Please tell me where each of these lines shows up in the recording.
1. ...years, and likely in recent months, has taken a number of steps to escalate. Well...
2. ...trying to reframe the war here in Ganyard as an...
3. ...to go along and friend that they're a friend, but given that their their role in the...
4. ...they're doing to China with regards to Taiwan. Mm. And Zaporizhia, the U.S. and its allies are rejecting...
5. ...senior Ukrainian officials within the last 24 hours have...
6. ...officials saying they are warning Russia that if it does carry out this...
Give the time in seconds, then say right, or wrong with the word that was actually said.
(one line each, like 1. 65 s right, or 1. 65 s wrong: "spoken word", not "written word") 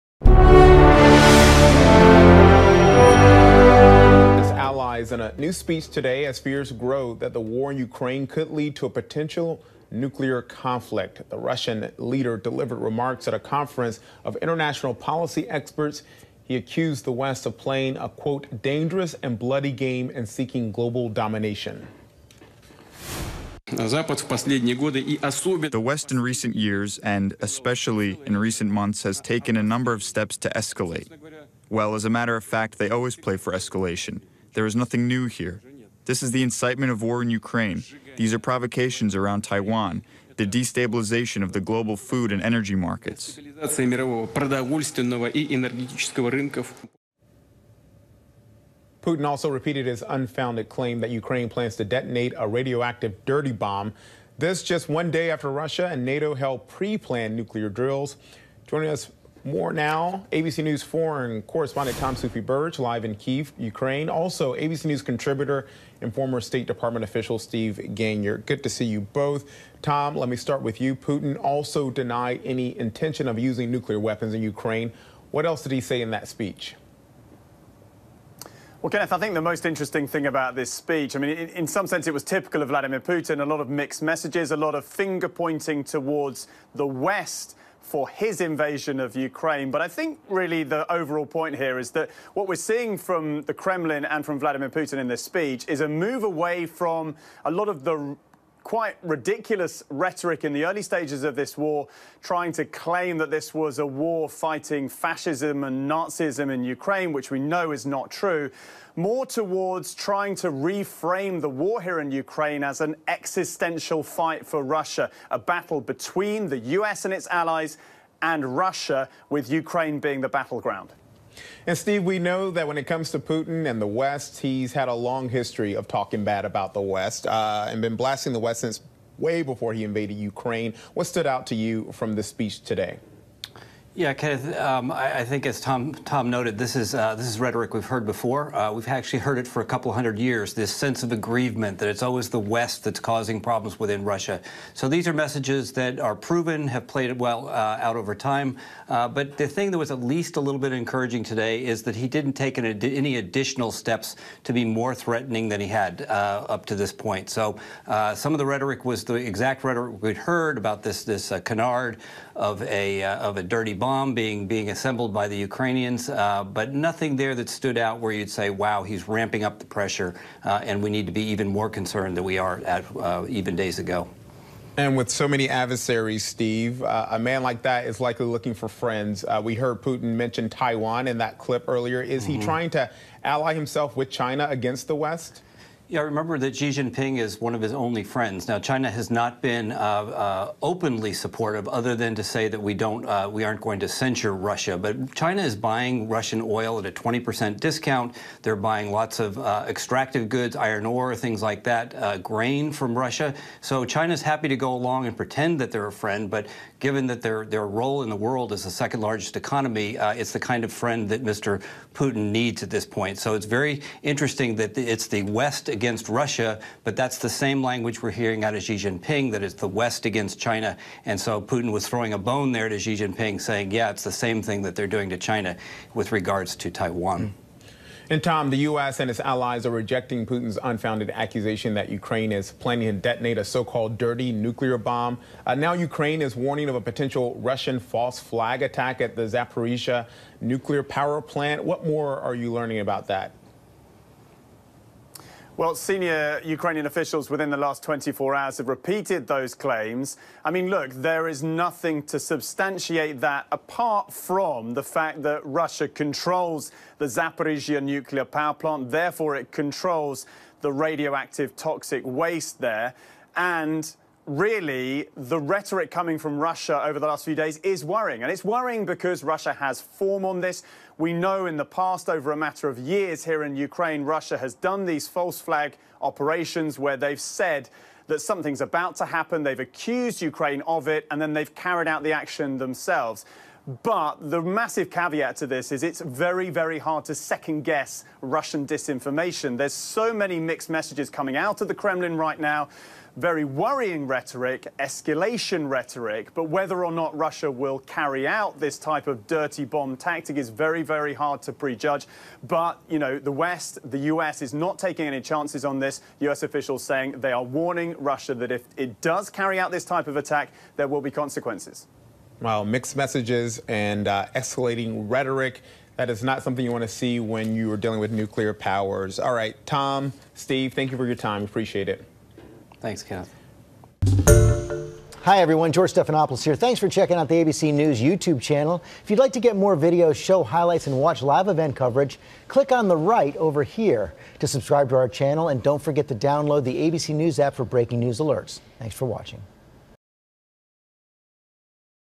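1. 26 s wrong: "especially", not "likely"
2. 109 s wrong: "Ukraine", not "Ganyard"
3. 204 s wrong: "pretend", not "friend"
4. 224 s wrong: "Tom", not "Zaporizhia"
5. 245 s right
6. 306 s right.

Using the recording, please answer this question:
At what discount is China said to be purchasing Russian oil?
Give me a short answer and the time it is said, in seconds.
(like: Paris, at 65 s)
20%, at 196 s.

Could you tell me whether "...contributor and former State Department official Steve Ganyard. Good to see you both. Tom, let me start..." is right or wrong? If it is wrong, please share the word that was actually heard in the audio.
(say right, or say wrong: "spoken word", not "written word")
right.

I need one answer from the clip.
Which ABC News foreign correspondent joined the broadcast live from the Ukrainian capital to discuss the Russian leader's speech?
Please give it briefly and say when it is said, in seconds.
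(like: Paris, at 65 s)
Tom Soufi Burridge, at 61 s.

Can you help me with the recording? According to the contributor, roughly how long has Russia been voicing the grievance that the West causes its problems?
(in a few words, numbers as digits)
a couple hundred years.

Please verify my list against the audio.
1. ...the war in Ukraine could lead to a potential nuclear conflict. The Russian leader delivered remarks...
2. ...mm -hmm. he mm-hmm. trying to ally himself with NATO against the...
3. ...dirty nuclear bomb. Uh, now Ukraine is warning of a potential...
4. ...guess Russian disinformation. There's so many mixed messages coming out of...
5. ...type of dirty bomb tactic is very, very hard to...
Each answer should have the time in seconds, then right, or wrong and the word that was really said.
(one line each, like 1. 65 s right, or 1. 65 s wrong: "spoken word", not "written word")
1. 7 s right
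2. 182 s wrong: "China", not "NATO"
3. 233 s right
4. 287 s right
5. 298 s right.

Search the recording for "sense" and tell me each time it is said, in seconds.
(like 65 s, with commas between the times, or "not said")
81 s, 140 s.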